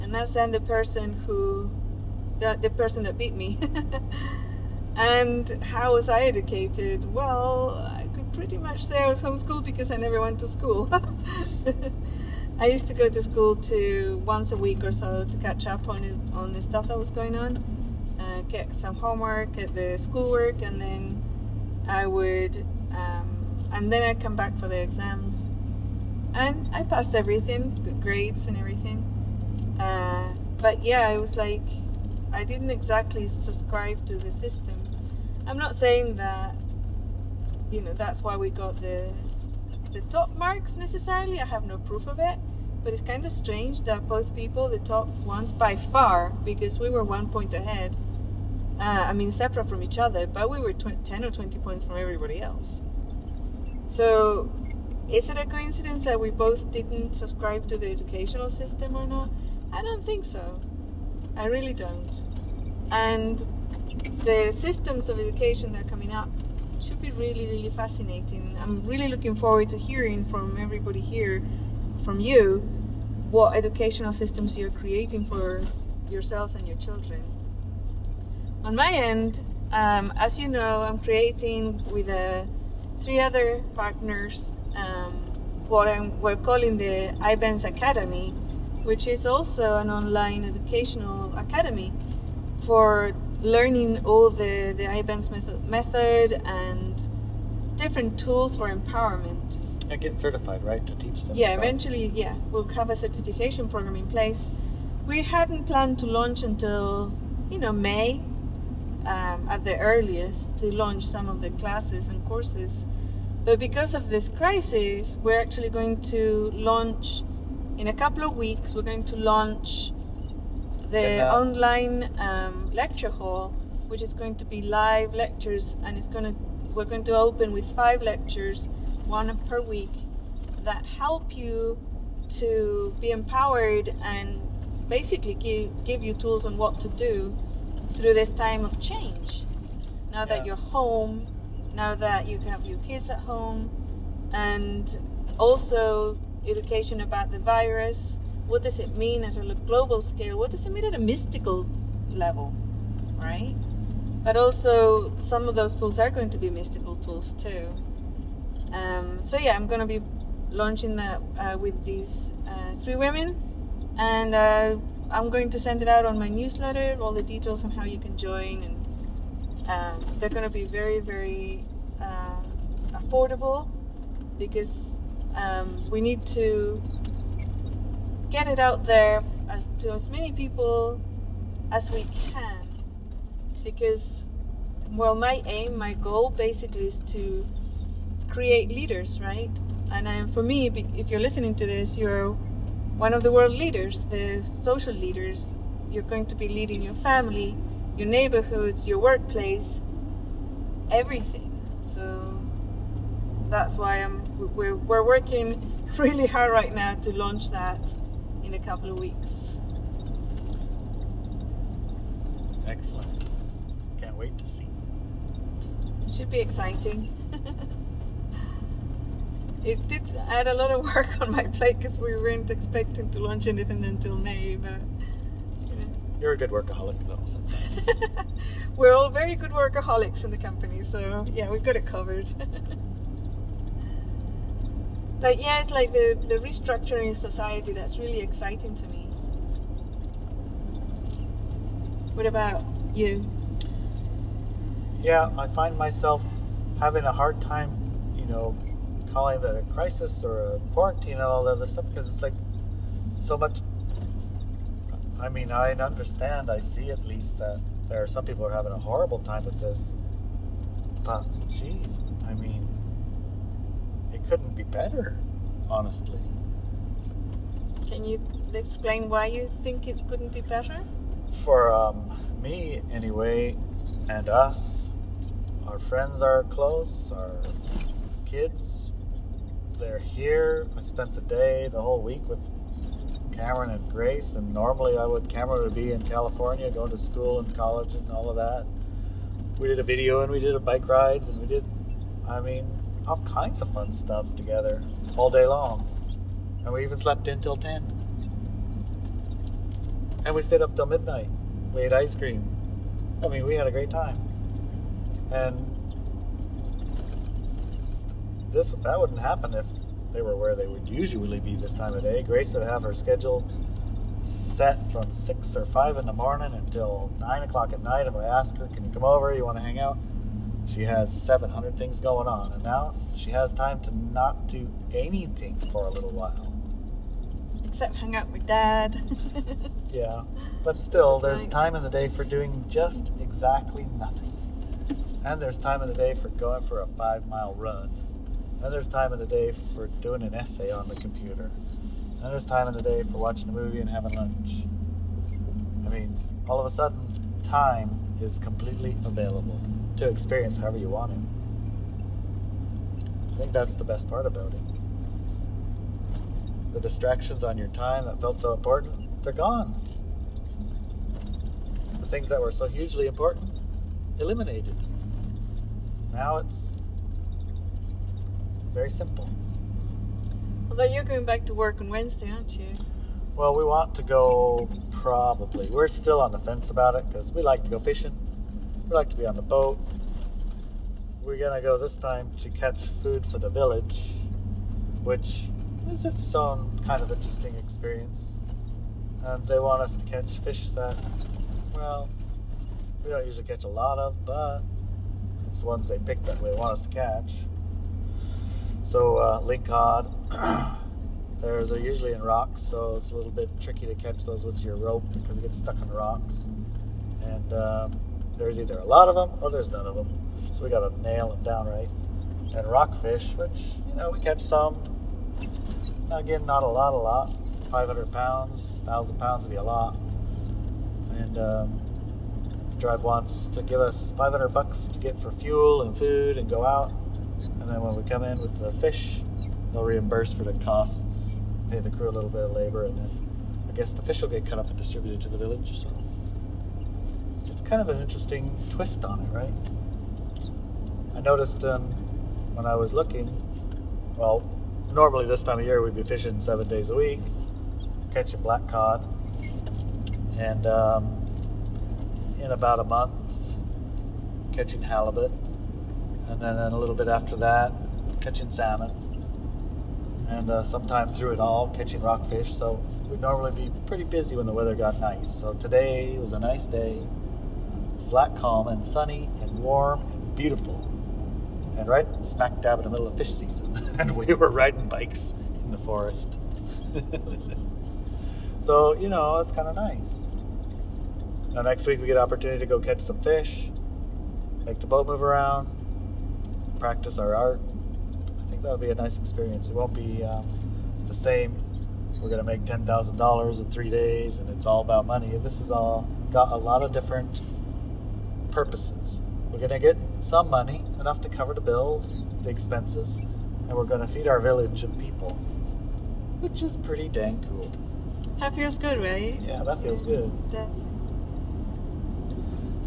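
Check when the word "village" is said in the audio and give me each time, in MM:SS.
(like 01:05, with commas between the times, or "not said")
06:23, 07:15, 08:24.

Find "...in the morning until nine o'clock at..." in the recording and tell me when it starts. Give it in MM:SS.
05:15.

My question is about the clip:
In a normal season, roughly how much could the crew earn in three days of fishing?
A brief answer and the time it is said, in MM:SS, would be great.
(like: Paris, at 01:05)
$10,000, at 08:12.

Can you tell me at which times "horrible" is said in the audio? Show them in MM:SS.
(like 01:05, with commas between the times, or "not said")
04:18.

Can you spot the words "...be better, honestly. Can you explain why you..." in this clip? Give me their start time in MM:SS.
04:24.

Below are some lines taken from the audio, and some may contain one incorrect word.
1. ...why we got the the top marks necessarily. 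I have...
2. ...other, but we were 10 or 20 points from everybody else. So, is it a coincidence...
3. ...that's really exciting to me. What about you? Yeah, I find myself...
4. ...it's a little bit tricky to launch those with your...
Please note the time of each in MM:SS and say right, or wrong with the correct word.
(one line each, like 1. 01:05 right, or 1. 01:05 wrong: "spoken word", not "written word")
1. 00:38 right
2. 00:49 right
3. 03:57 right
4. 06:42 wrong: "catch", not "launch".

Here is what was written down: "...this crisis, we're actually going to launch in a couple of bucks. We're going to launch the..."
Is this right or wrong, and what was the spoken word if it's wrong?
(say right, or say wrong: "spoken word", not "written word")
wrong: "weeks", not "bucks".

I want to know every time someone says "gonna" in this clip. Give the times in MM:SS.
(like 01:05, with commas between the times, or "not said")
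02:39, 02:50.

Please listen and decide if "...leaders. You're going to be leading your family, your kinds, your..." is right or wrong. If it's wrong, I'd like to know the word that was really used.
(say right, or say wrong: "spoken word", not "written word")
wrong: "neighborhoods", not "kinds".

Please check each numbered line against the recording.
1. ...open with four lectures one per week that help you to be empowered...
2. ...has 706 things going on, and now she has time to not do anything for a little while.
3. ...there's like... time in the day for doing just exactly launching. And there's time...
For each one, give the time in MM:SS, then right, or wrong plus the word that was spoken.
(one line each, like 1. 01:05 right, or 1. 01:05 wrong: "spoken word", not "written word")
1. 02:07 wrong: "five", not "four"
2. 05:20 wrong: "700", not "706"
3. 05:31 wrong: "nothing", not "launching".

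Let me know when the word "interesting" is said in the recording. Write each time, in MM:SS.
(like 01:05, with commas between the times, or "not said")
06:27, 07:17.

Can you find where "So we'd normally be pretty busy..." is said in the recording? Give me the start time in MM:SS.
07:42.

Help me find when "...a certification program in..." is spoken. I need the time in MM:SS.
01:42.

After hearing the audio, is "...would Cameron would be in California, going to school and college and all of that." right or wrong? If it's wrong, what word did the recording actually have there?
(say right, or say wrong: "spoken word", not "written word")
right.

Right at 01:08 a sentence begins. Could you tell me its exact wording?
I'm really looking forward to hearing from everybody here from you what educational systems you're creating for yourselves and your children.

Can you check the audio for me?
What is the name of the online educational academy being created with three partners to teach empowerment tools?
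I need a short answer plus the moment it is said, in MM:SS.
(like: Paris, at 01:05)
IBenz Academy, at 01:27.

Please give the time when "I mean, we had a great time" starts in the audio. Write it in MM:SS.
05:03.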